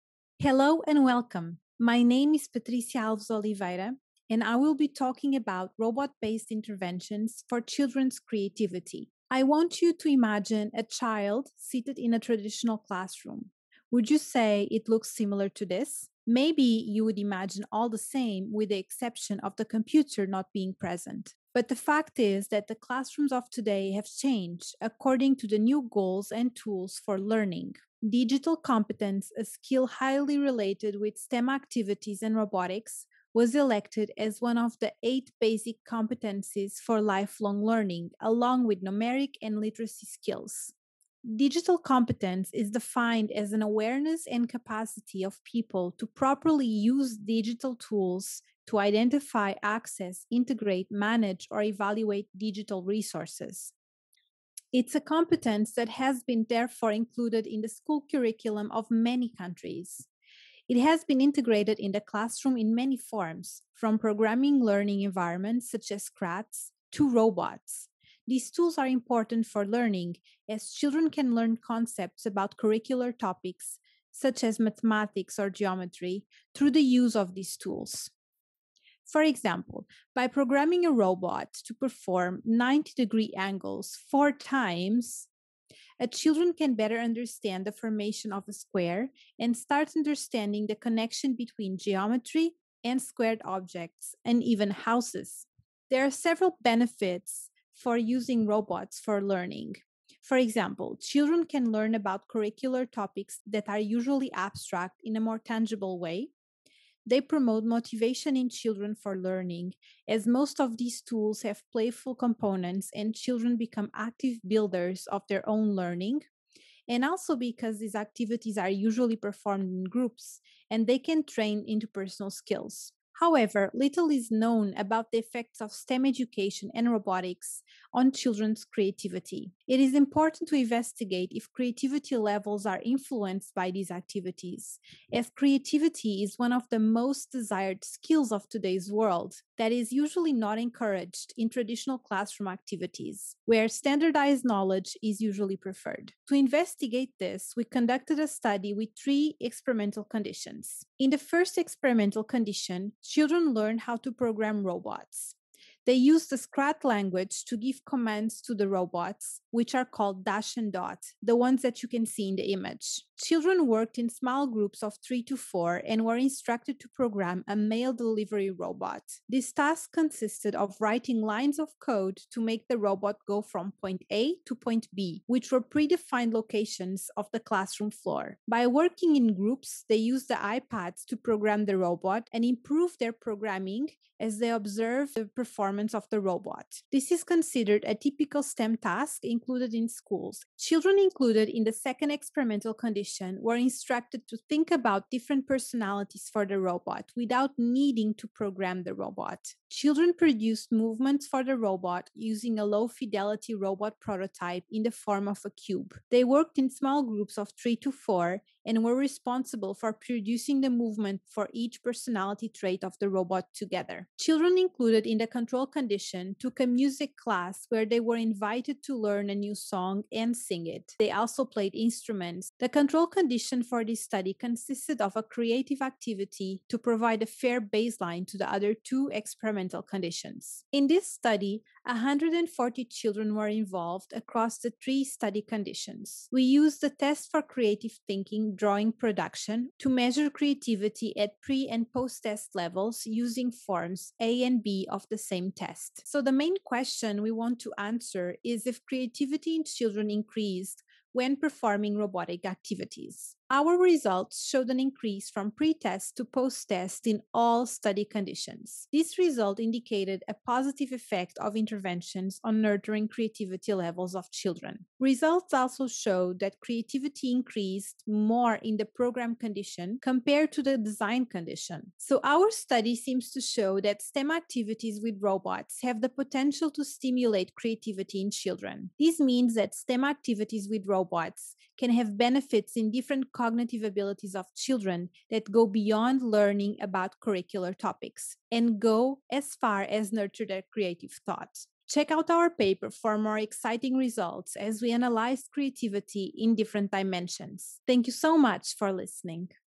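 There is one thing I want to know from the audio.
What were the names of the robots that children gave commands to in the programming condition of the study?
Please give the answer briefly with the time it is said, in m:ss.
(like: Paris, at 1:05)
Dash and Dot, at 2:40.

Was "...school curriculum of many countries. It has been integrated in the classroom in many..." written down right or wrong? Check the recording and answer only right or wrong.
right.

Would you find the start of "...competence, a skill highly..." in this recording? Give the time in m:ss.
0:28.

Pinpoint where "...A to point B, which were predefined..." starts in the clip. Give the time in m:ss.
2:54.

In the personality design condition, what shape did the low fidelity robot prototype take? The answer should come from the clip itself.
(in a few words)
a cube.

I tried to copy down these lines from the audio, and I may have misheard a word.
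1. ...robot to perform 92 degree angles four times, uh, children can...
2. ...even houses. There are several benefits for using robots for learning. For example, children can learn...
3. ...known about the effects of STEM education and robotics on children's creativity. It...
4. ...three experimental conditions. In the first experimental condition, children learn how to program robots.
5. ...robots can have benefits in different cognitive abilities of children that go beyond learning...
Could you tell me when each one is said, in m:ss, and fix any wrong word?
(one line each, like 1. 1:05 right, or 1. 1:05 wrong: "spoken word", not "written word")
1. 1:20 wrong: "90", not "92"
2. 1:34 right
3. 2:04 right
4. 2:29 right
5. 4:40 right.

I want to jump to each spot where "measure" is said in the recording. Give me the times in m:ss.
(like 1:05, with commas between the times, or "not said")
3:59.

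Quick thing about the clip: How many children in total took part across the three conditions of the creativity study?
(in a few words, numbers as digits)
140.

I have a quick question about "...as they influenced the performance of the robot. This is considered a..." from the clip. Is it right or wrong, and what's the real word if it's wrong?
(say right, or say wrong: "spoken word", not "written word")
wrong: "observed", not "influenced".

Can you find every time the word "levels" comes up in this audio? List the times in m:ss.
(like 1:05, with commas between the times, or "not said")
2:12, 4:02, 4:23.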